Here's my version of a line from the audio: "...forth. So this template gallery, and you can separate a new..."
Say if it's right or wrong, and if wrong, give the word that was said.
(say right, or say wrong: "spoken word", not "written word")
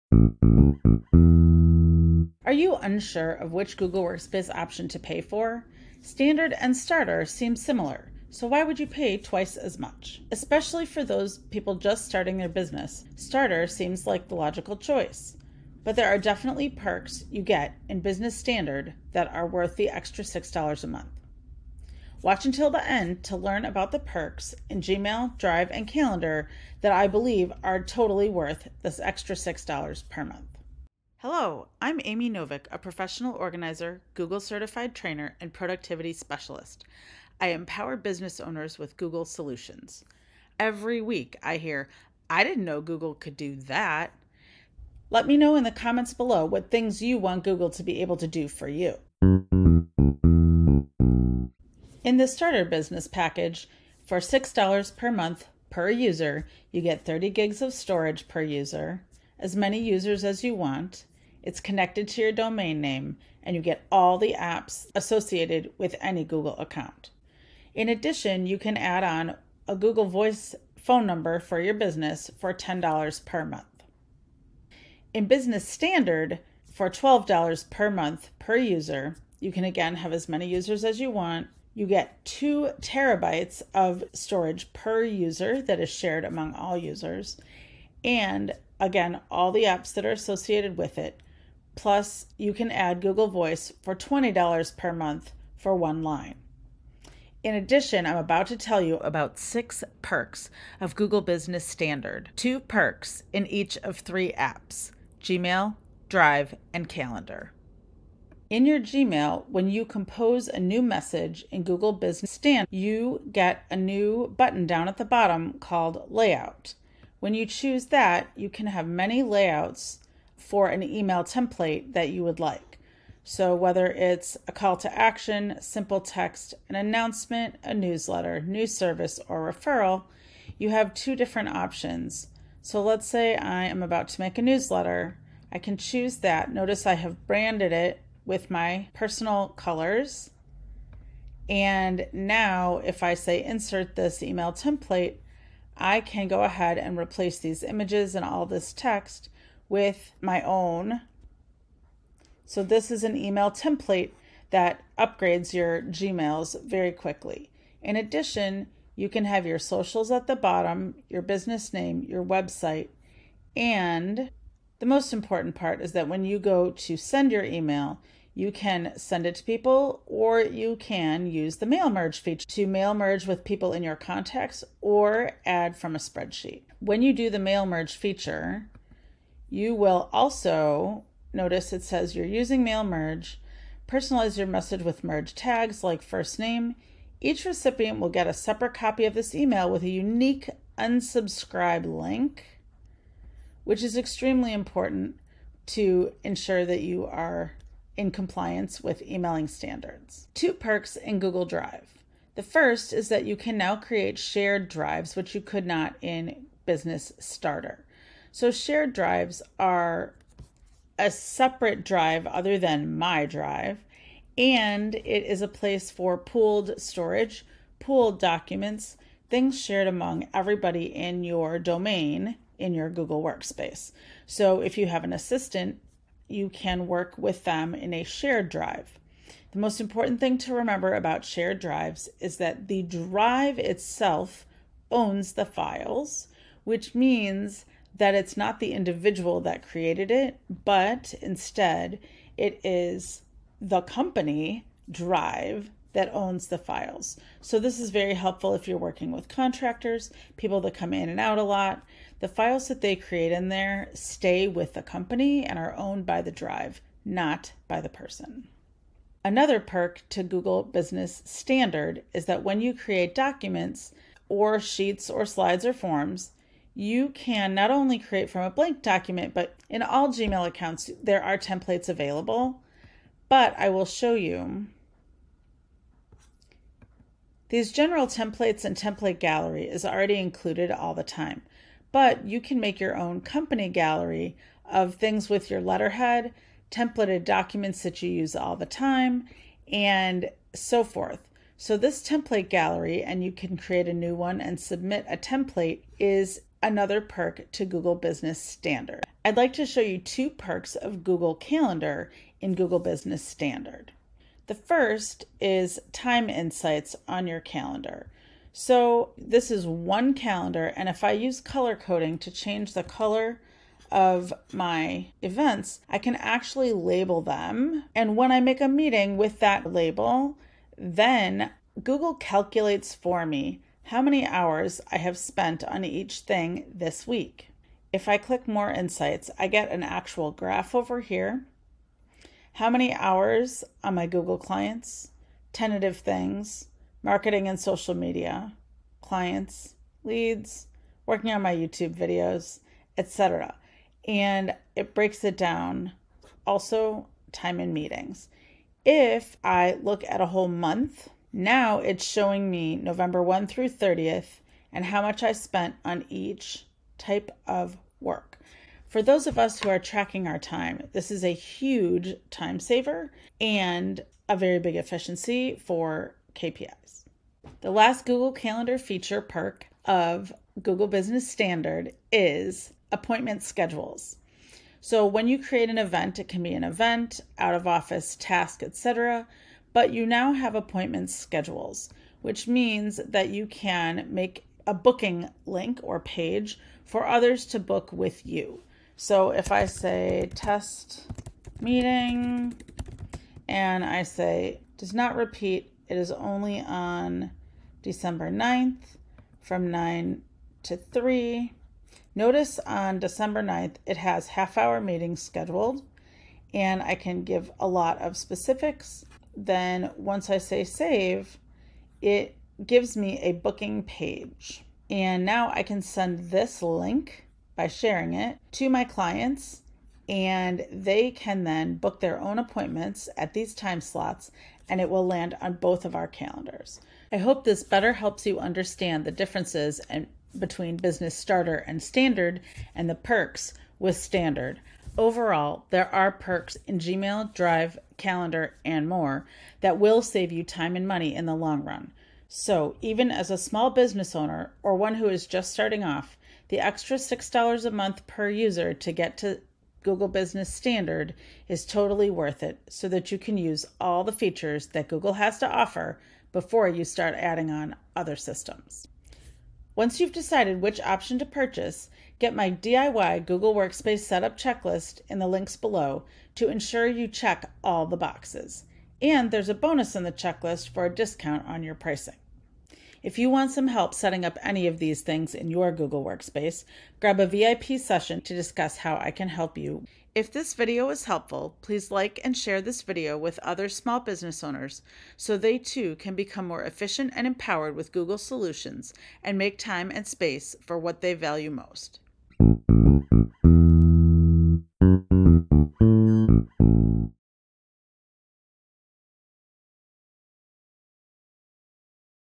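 wrong: "create", not "separate".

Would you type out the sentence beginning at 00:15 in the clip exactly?
But there are definitely perks you get in Business Standard that are worth the extra $6 a month.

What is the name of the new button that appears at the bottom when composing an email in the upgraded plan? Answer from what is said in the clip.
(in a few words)
Layout.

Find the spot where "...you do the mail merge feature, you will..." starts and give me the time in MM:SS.
02:57.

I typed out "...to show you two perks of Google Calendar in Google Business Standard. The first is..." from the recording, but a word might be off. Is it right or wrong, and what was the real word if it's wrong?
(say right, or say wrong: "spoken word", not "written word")
right.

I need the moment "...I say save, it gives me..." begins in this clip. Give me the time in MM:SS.
06:50.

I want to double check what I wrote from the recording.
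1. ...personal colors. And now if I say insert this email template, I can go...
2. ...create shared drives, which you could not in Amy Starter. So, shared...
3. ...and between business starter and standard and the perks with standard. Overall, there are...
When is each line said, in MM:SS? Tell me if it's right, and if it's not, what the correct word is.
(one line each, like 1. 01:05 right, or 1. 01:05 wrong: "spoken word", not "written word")
1. 02:18 right
2. 03:23 wrong: "Business", not "Amy"
3. 07:09 right.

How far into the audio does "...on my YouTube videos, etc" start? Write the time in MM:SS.
05:41.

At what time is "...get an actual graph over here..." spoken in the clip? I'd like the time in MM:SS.
05:29.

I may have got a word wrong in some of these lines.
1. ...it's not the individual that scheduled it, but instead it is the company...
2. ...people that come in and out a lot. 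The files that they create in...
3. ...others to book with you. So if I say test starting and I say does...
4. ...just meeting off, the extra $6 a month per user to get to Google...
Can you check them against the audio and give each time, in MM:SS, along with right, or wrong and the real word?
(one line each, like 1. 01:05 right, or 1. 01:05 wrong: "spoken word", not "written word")
1. 03:58 wrong: "created", not "scheduled"
2. 04:10 right
3. 06:27 wrong: "meeting", not "starting"
4. 07:25 wrong: "starting", not "meeting".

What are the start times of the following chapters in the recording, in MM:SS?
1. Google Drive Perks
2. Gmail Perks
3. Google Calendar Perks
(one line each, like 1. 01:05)
1. 03:20
2. 01:48
3. 05:00.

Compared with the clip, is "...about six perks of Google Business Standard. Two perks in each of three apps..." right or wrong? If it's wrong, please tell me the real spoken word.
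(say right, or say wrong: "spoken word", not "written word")
right.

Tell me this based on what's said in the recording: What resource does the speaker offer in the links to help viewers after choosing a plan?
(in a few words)
DIY Google Workspace Setup Checklist.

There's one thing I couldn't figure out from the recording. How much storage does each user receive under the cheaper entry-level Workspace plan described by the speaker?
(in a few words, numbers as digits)
30 gigs.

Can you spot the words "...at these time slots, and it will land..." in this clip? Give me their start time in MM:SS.
07:03.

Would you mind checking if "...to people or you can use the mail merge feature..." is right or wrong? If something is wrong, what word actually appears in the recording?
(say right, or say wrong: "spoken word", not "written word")
right.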